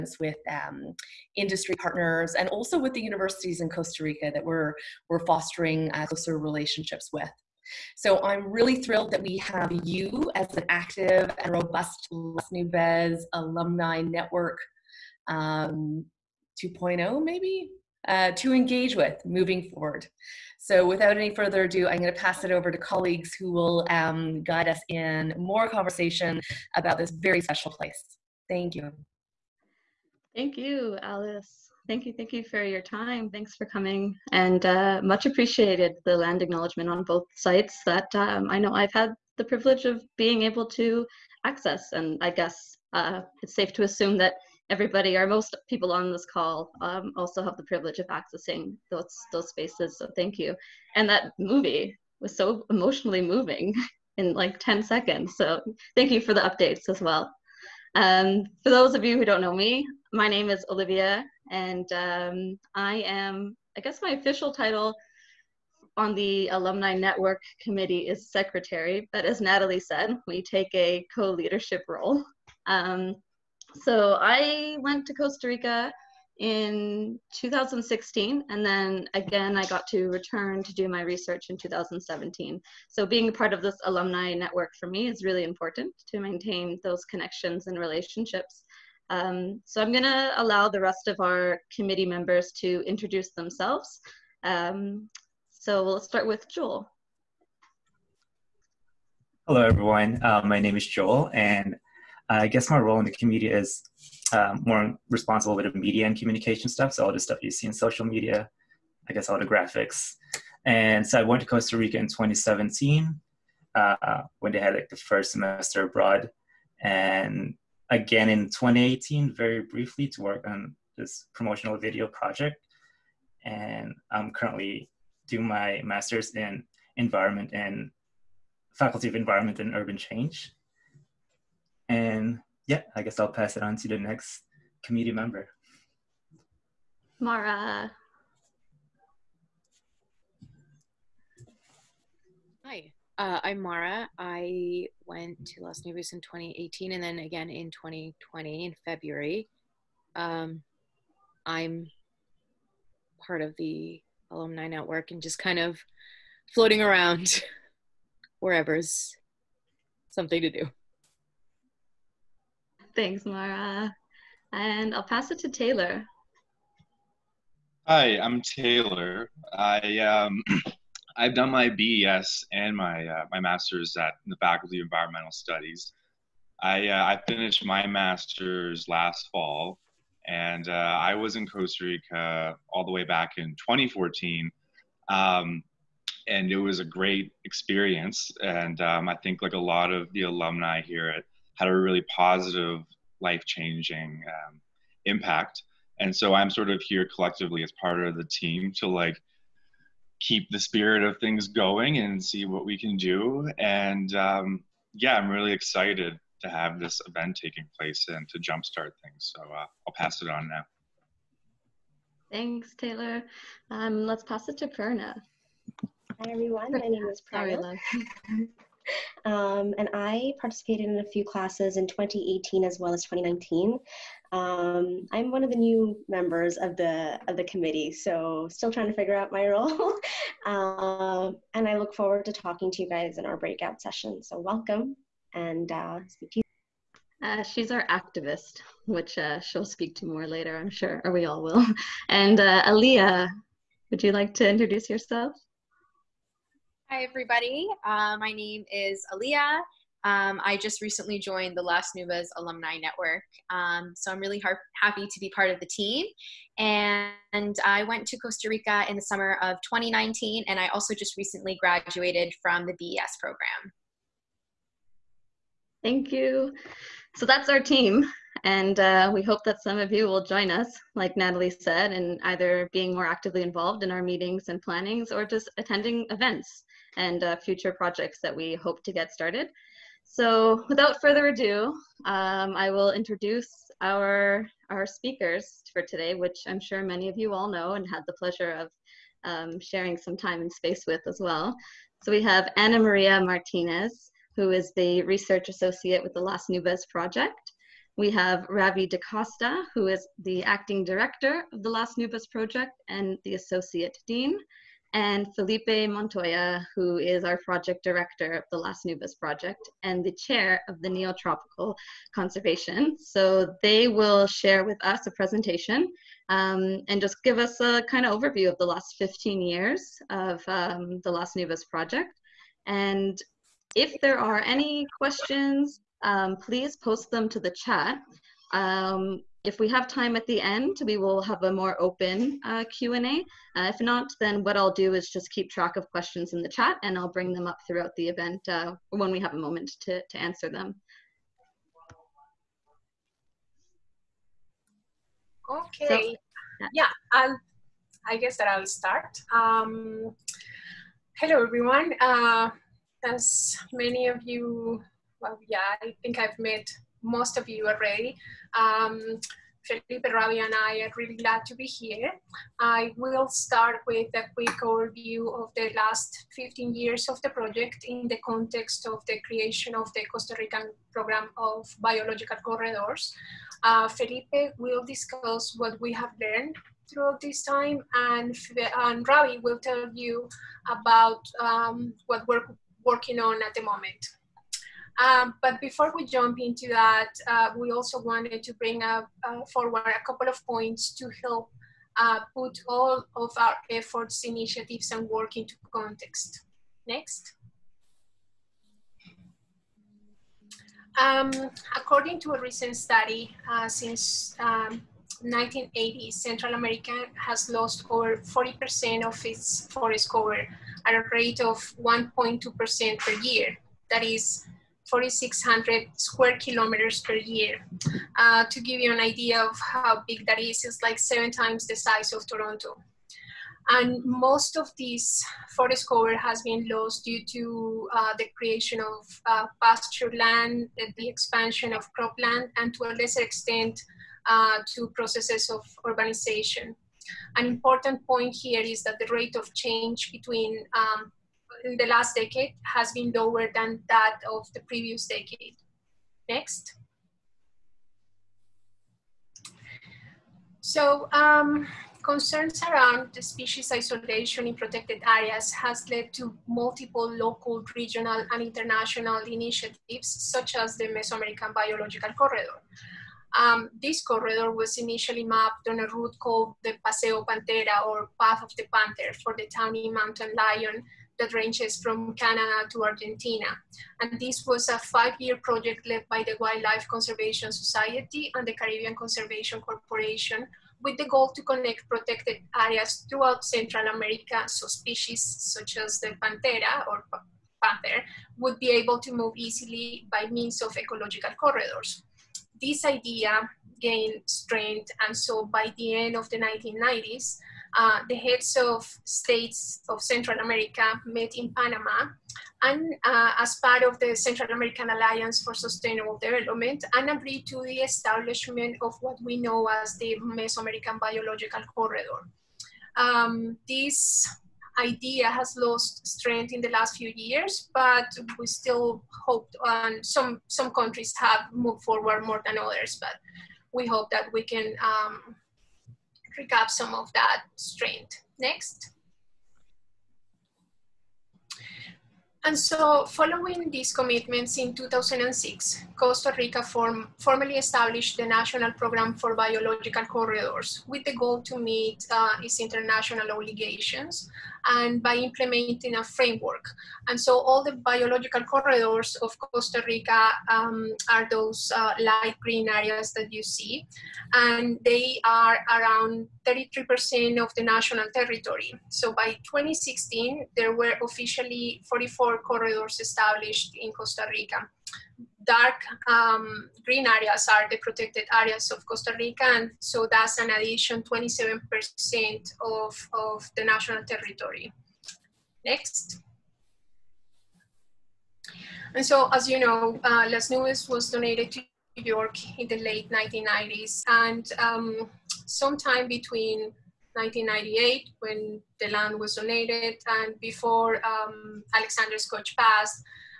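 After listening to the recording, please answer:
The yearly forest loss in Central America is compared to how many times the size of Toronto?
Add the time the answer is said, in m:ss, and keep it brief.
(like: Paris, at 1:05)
7, at 7:00.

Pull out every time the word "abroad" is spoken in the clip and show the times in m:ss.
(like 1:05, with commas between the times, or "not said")
1:55.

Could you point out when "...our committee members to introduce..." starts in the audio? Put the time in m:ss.
1:31.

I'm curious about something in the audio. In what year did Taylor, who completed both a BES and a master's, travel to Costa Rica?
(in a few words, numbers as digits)
2014.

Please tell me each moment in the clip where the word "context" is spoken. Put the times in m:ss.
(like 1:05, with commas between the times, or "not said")
6:08, 6:35.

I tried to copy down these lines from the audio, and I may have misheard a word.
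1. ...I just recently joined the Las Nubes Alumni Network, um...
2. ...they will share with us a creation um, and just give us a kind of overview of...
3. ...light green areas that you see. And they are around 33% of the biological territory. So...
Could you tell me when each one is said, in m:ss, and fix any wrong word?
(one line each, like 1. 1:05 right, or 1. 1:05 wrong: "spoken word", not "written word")
1. 4:10 right
2. 5:13 wrong: "presentation", not "creation"
3. 9:11 wrong: "national", not "biological".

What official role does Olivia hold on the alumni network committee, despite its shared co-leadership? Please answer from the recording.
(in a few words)
Secretary.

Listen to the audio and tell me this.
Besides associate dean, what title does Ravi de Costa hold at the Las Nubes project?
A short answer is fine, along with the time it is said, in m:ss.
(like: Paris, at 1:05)
Acting director, at 5:00.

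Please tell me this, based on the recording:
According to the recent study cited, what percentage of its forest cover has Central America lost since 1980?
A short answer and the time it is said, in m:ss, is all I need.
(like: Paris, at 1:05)
40%, at 6:48.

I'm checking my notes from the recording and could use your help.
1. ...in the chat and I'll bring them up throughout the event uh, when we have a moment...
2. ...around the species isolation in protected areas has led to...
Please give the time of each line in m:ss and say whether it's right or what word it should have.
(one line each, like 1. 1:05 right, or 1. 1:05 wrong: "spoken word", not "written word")
1. 5:36 right
2. 7:32 right.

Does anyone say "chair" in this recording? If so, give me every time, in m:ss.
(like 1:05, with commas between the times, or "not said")
5:10.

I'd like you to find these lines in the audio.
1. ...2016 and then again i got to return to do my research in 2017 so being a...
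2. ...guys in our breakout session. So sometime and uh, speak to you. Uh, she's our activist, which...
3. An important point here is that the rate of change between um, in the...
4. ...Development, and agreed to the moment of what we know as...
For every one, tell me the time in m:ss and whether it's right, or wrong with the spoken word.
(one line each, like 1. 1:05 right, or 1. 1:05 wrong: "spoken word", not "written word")
1. 1:17 right
2. 3:52 wrong: "welcome", not "sometime"
3. 7:17 right
4. 8:26 wrong: "establishment", not "moment".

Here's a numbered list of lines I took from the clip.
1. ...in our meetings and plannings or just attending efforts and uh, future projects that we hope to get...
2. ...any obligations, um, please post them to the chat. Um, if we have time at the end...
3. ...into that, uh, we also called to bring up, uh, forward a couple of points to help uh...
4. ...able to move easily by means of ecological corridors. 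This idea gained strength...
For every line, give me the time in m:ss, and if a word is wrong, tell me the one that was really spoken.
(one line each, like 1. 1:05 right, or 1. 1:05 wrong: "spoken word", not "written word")
1. 4:33 wrong: "events", not "efforts"
2. 5:24 wrong: "questions", not "obligations"
3. 6:26 wrong: "wanted", not "called"
4. 8:08 right.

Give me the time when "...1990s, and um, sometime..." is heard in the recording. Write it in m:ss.
9:43.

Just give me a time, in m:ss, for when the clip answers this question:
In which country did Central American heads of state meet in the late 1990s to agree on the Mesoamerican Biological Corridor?
8:21.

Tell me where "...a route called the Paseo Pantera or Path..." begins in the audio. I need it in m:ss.
7:45.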